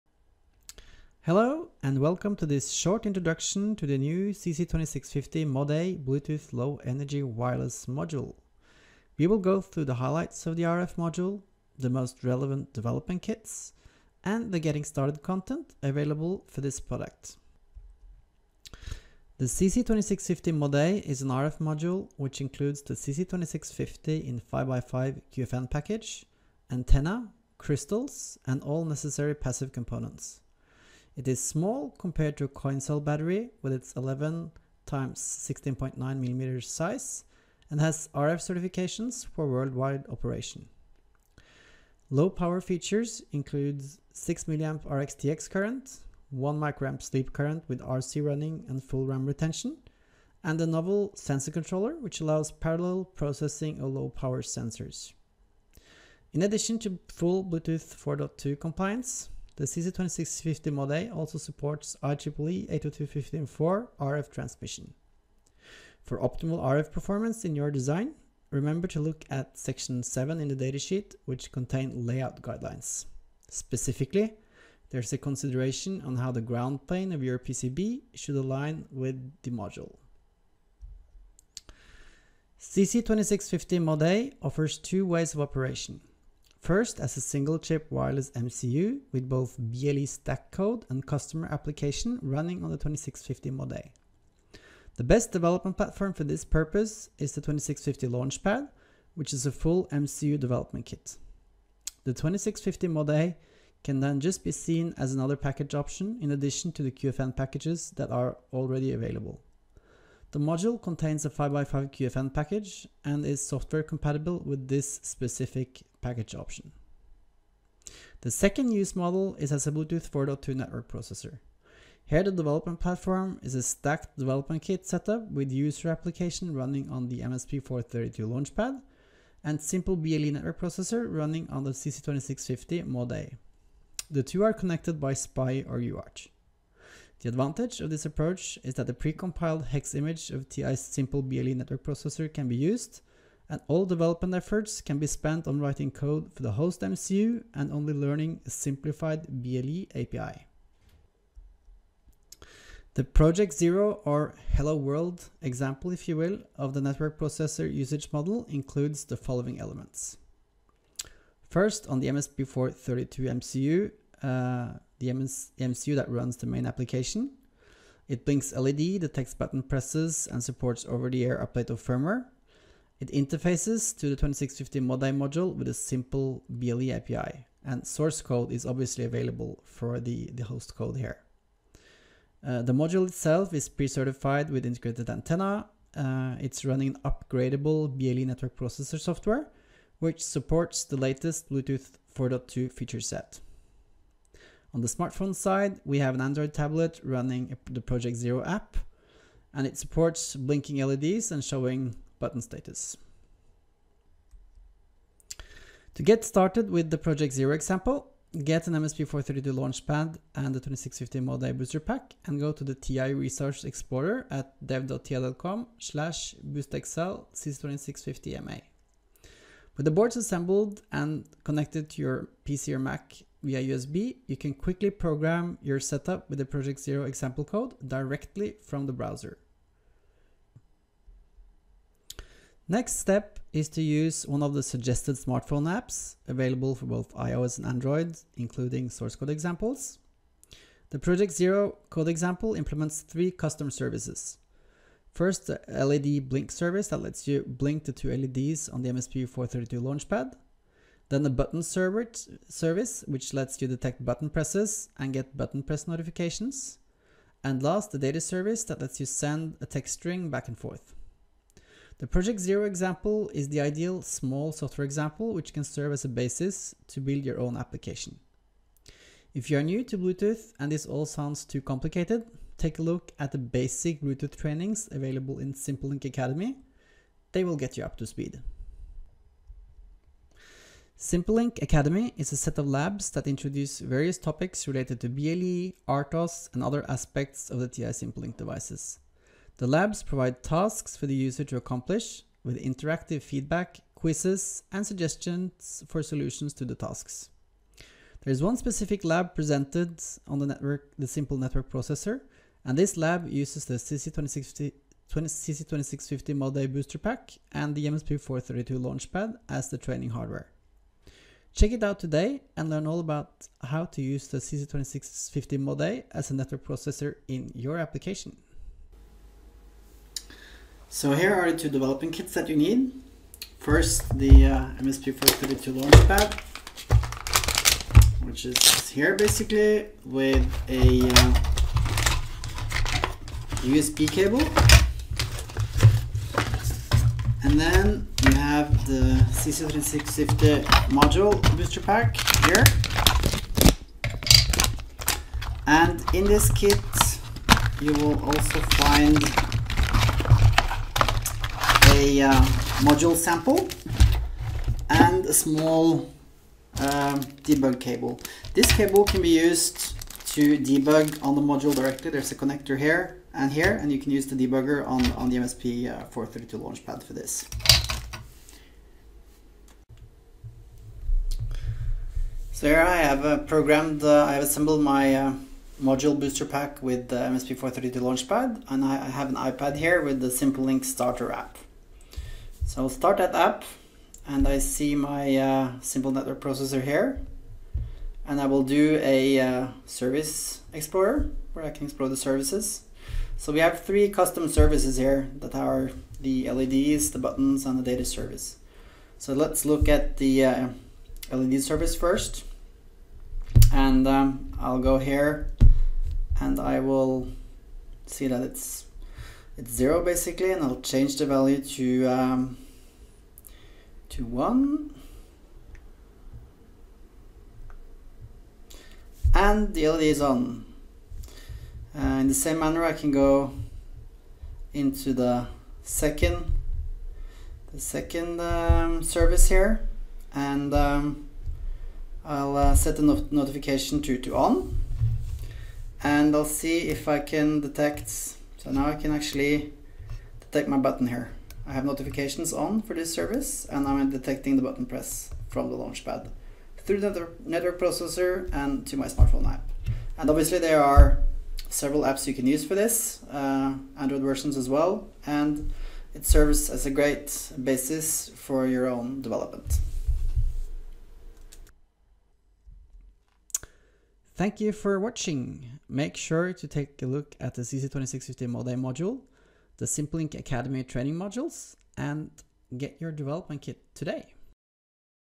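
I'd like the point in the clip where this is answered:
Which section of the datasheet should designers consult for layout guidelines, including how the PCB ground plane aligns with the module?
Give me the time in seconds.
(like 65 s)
69 s.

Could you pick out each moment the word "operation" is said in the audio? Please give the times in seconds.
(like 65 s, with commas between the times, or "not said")
40 s, 85 s.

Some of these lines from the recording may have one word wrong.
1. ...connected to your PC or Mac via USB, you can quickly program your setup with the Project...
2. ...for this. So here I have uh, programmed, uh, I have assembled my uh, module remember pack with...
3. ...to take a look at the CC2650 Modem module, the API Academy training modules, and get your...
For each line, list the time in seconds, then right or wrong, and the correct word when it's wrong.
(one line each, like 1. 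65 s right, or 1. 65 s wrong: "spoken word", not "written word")
1. 221 s right
2. 367 s wrong: "booster", not "remember"
3. 466 s wrong: "SimpleLink", not "API".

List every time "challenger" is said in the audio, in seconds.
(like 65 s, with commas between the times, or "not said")
not said.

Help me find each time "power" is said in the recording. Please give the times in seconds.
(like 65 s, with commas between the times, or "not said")
42 s, 54 s.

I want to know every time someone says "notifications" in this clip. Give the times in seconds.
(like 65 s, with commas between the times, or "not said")
255 s, 433 s, 441 s.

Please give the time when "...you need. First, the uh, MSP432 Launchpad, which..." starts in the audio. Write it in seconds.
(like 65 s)
322 s.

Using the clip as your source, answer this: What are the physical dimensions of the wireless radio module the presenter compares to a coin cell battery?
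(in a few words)
11 x 16.9 mm.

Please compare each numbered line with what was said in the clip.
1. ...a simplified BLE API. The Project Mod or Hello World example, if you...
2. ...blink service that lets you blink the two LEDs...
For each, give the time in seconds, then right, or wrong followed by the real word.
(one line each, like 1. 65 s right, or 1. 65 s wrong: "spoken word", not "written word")
1. 148 s wrong: "Zero", not "Mod"
2. 246 s right.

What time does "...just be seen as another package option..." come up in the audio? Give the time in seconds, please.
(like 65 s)
104 s.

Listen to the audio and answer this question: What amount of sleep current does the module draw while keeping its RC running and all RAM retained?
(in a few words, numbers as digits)
1 microamp.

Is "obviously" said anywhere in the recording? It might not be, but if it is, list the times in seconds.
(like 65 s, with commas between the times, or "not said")
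178 s, 450 s.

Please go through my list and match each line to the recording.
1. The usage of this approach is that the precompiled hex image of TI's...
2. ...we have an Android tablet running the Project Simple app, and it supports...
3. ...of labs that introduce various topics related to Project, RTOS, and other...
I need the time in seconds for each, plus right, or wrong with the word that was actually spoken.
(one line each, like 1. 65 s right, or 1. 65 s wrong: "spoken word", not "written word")
1. 137 s wrong: "advantage", not "usage"
2. 195 s wrong: "Zero", not "Simple"
3. 282 s wrong: "BLE", not "Project".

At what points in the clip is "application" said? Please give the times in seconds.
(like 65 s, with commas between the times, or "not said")
91 s, 125 s, 166 s, 267 s, 317 s.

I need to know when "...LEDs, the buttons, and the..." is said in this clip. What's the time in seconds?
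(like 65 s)
396 s.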